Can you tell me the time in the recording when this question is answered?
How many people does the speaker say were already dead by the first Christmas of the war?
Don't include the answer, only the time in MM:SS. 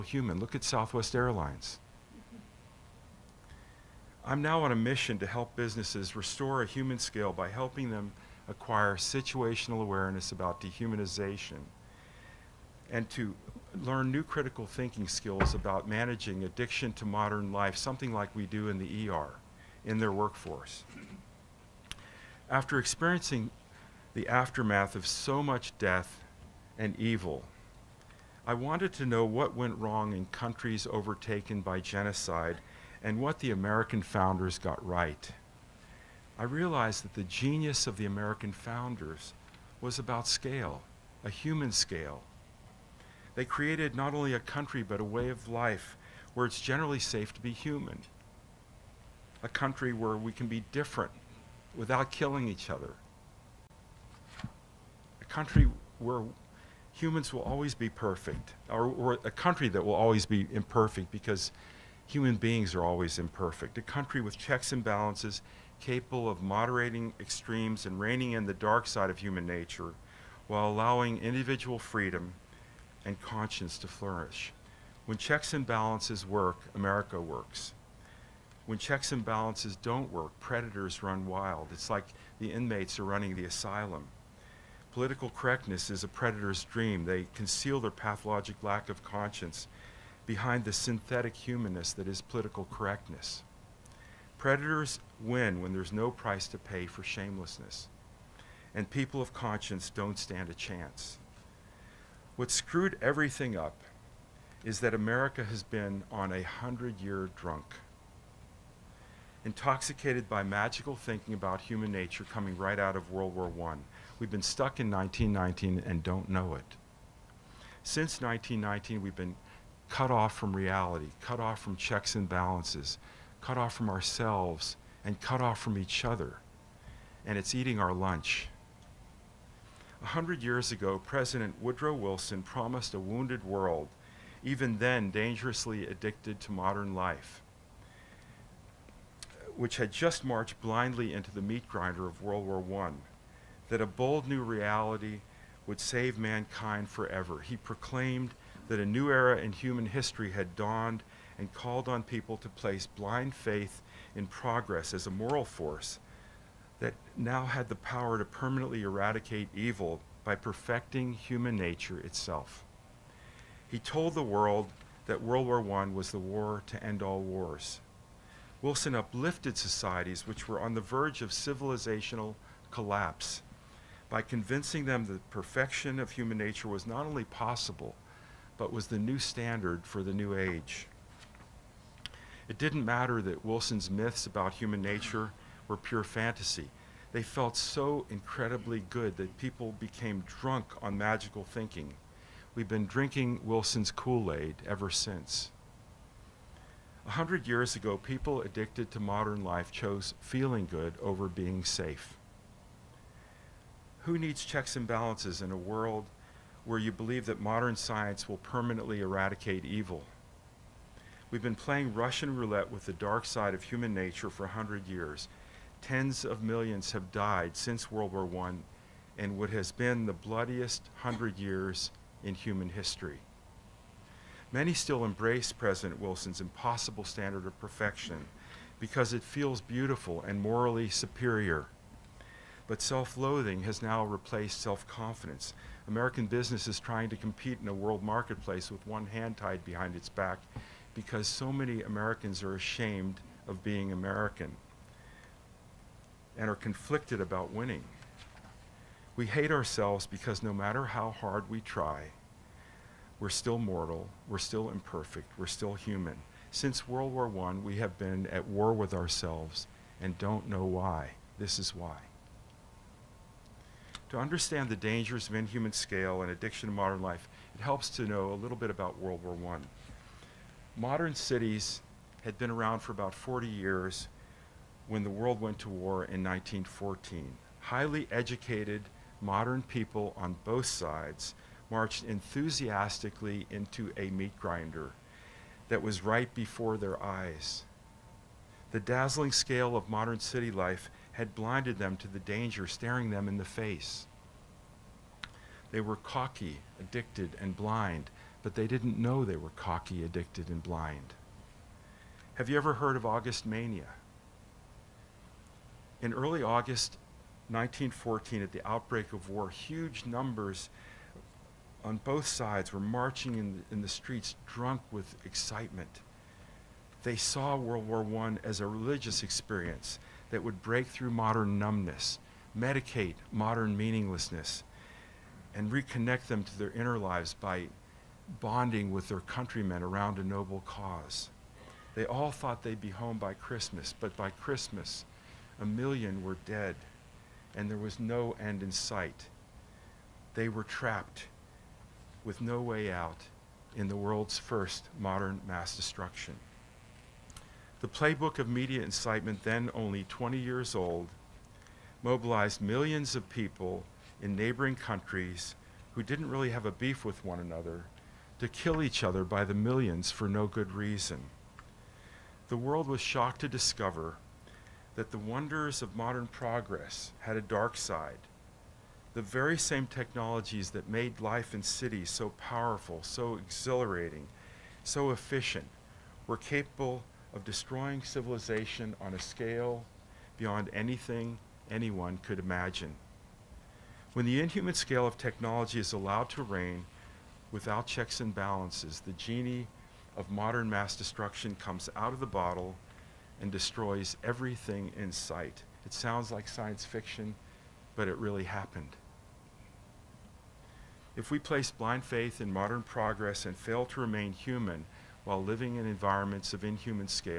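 05:35.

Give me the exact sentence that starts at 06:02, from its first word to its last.
The world was shocked to discover that the wonders of modern progress had a dark side.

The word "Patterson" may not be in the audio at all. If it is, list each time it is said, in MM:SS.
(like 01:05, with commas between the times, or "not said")
not said.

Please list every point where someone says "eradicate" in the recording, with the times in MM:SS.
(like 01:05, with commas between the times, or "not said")
02:38, 03:29.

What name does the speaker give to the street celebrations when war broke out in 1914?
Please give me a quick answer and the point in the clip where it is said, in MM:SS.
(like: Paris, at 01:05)
August Mania, at 05:03.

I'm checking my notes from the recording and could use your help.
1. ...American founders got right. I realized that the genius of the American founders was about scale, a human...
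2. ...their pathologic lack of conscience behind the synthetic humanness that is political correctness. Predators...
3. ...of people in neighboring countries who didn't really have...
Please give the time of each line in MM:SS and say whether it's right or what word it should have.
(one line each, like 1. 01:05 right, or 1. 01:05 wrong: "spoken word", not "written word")
1. 00:33 right
2. 01:27 right
3. 05:53 right.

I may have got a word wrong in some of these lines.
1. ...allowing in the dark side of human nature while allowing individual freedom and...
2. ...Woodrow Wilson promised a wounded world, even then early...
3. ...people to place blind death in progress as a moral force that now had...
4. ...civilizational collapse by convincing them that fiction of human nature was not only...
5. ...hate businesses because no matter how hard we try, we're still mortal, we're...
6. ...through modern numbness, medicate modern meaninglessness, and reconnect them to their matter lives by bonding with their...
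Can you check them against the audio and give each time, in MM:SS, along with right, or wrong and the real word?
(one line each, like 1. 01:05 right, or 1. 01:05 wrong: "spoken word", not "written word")
1. 01:07 wrong: "reining", not "allowing"
2. 02:11 wrong: "dangerously", not "early"
3. 02:32 wrong: "faith", not "death"
4. 02:51 wrong: "perfection", not "fiction"
5. 04:09 wrong: "ourselves", not "businesses"
6. 05:20 wrong: "inner", not "matter".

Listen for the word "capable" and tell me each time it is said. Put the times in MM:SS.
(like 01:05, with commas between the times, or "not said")
01:05, 06:16.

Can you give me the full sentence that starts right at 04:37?
Highly educated modern people on both sides marched enthusiastically into a meat grinder that was right before their eyes.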